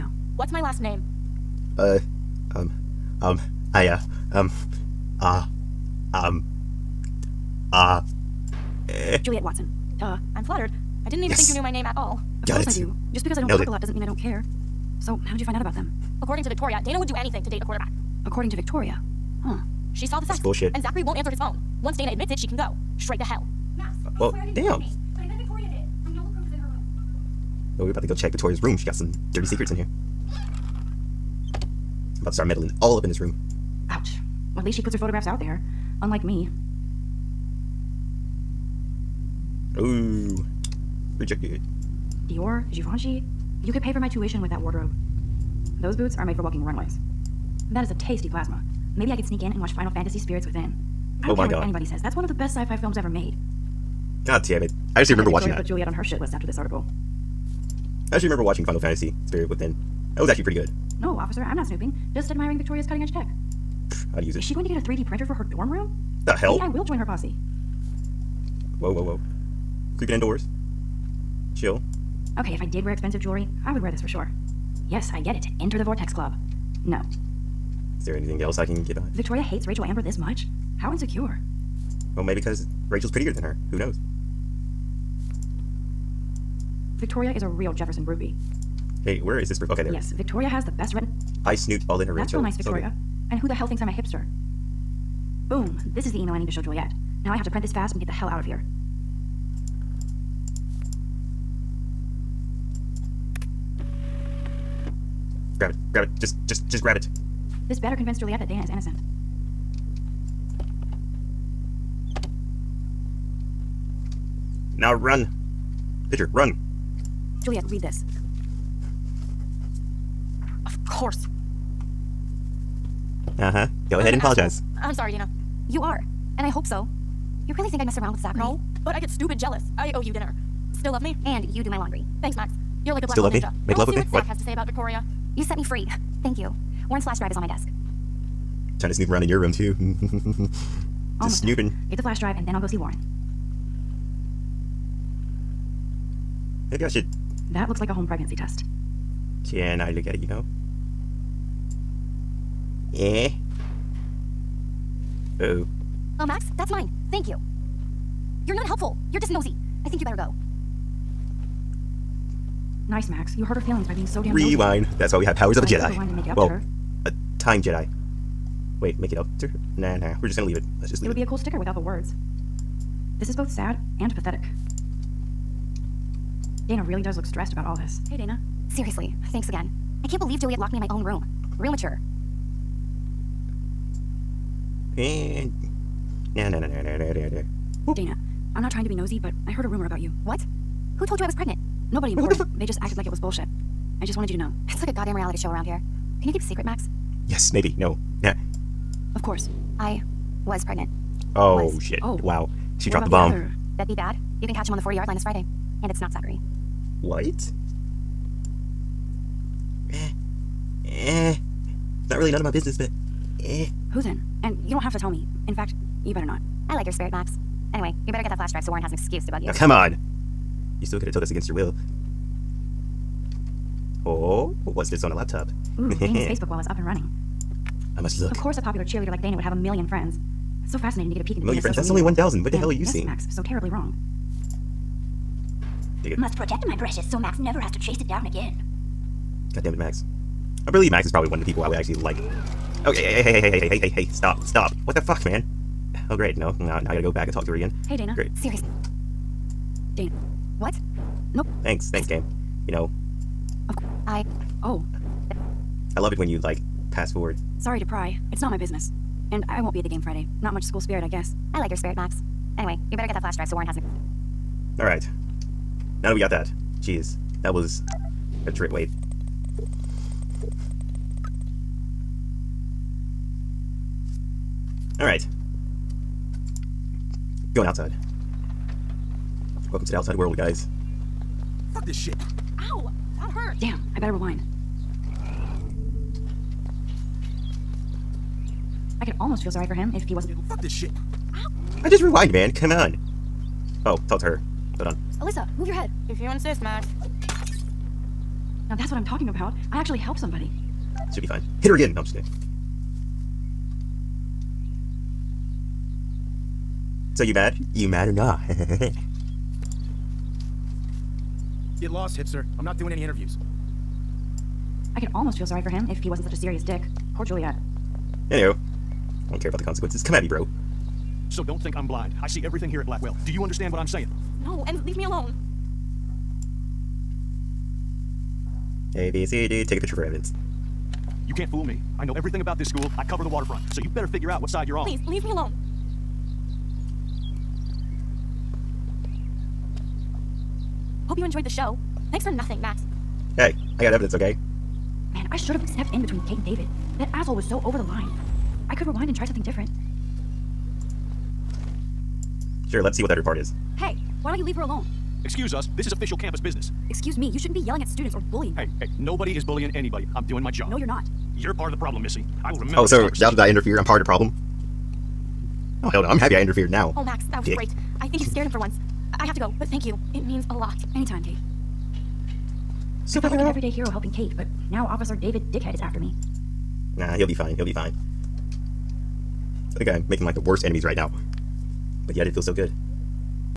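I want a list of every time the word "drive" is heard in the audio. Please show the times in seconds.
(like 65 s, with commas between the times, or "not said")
137 s, 142 s, 218 s, 263 s.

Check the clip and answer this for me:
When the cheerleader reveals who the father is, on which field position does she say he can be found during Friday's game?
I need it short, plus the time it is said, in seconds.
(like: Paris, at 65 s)
40-yard line, at 204 s.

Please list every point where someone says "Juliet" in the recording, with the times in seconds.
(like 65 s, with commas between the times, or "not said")
9 s, 55 s, 96 s, 108 s, 117 s, 180 s, 317 s.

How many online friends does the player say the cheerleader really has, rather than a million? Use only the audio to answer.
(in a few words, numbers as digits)
1,000.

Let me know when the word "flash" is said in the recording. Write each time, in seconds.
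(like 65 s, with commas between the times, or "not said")
137 s, 142 s, 218 s, 263 s.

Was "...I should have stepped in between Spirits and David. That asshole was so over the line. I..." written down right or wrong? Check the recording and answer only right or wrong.
wrong.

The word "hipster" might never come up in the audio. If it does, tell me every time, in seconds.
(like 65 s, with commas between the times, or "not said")
93 s, 312 s.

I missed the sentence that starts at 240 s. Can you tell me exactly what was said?
I believe Max is probably one of the people I would actually like.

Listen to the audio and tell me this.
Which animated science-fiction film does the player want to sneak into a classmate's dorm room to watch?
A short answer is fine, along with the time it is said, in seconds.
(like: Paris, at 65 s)
Final Fantasy Spirits Within, at 49 s.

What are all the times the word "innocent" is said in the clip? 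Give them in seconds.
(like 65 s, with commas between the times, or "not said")
108 s.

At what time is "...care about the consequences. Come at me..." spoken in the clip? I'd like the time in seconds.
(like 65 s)
319 s.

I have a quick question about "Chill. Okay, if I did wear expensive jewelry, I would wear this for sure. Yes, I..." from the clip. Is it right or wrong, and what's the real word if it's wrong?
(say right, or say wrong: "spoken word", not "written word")
right.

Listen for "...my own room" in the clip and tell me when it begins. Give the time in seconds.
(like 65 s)
180 s.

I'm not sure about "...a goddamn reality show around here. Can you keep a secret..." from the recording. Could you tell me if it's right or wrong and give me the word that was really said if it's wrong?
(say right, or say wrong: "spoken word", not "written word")
right.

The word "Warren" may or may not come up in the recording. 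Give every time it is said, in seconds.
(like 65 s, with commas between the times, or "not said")
136 s, 142 s, 218 s, 263 s.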